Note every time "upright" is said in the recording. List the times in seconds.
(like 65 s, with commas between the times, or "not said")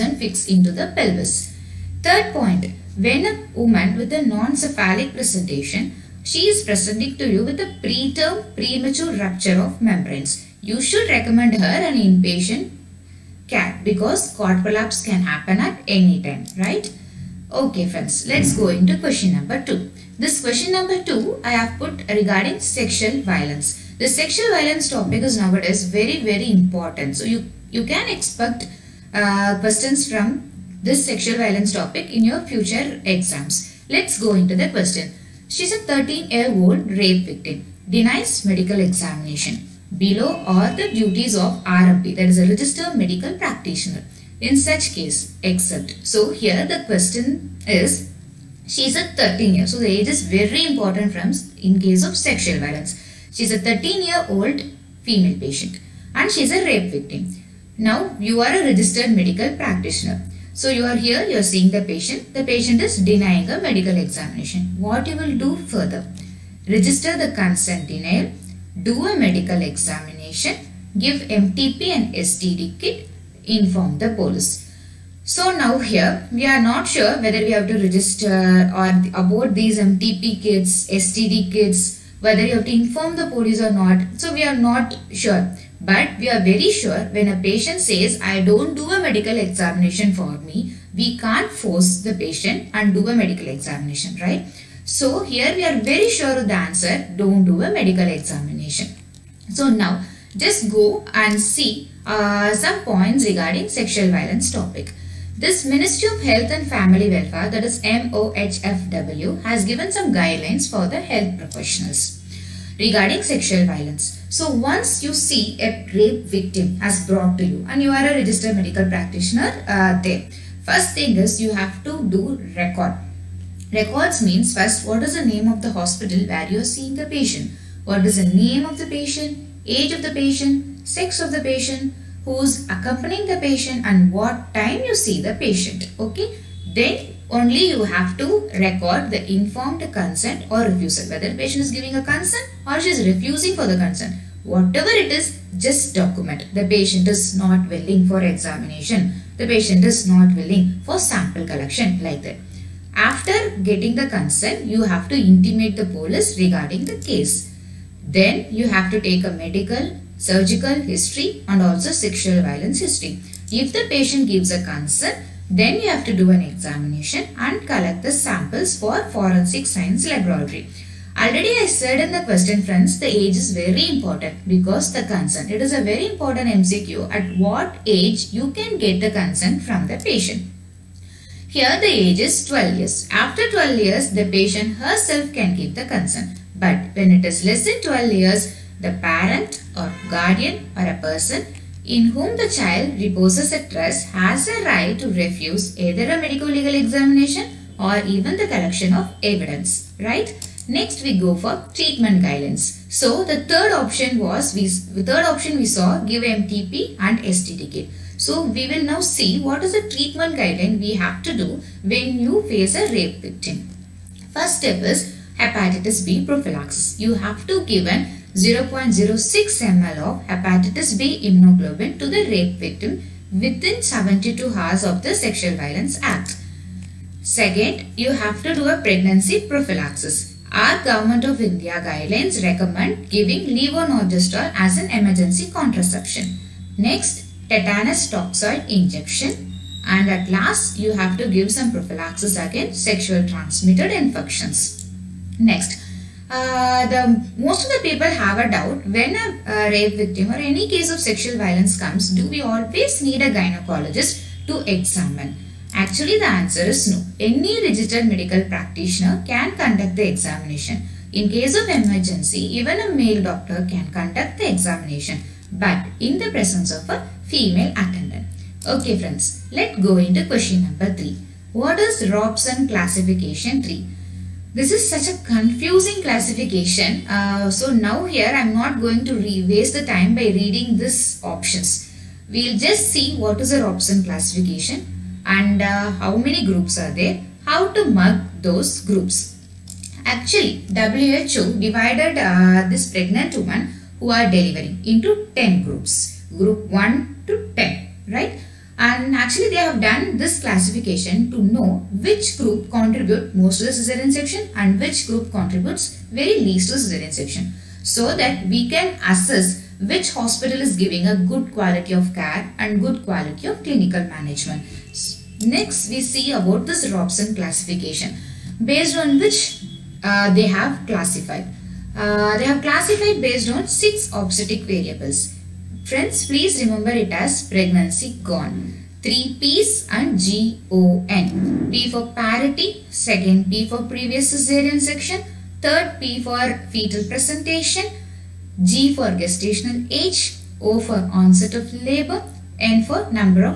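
not said.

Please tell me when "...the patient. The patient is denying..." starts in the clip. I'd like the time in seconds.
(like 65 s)
61 s.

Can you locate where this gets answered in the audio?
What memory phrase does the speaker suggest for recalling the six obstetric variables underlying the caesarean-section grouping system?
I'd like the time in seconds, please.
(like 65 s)
327 s.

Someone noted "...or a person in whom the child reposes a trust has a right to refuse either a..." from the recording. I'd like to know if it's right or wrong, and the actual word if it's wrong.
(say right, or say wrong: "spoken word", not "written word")
right.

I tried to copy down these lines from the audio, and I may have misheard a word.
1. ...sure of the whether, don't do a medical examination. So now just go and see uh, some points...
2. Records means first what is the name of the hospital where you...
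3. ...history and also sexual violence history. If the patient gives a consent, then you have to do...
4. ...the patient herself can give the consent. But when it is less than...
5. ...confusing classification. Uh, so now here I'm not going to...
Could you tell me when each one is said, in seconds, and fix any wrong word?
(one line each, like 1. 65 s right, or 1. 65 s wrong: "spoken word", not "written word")
1. 96 s wrong: "answer", not "whether"
2. 123 s right
3. 160 s right
4. 184 s right
5. 275 s right.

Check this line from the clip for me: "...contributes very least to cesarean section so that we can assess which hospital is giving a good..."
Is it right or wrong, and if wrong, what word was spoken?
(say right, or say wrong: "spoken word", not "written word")
right.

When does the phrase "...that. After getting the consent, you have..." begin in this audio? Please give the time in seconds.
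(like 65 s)
152 s.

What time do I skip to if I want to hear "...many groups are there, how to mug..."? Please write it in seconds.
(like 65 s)
286 s.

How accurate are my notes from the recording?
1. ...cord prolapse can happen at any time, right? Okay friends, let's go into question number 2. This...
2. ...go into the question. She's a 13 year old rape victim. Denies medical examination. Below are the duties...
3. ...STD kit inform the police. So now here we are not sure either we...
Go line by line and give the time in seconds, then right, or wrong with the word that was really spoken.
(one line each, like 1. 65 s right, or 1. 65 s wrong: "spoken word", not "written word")
1. 14 s right
2. 34 s right
3. 72 s wrong: "whether", not "either".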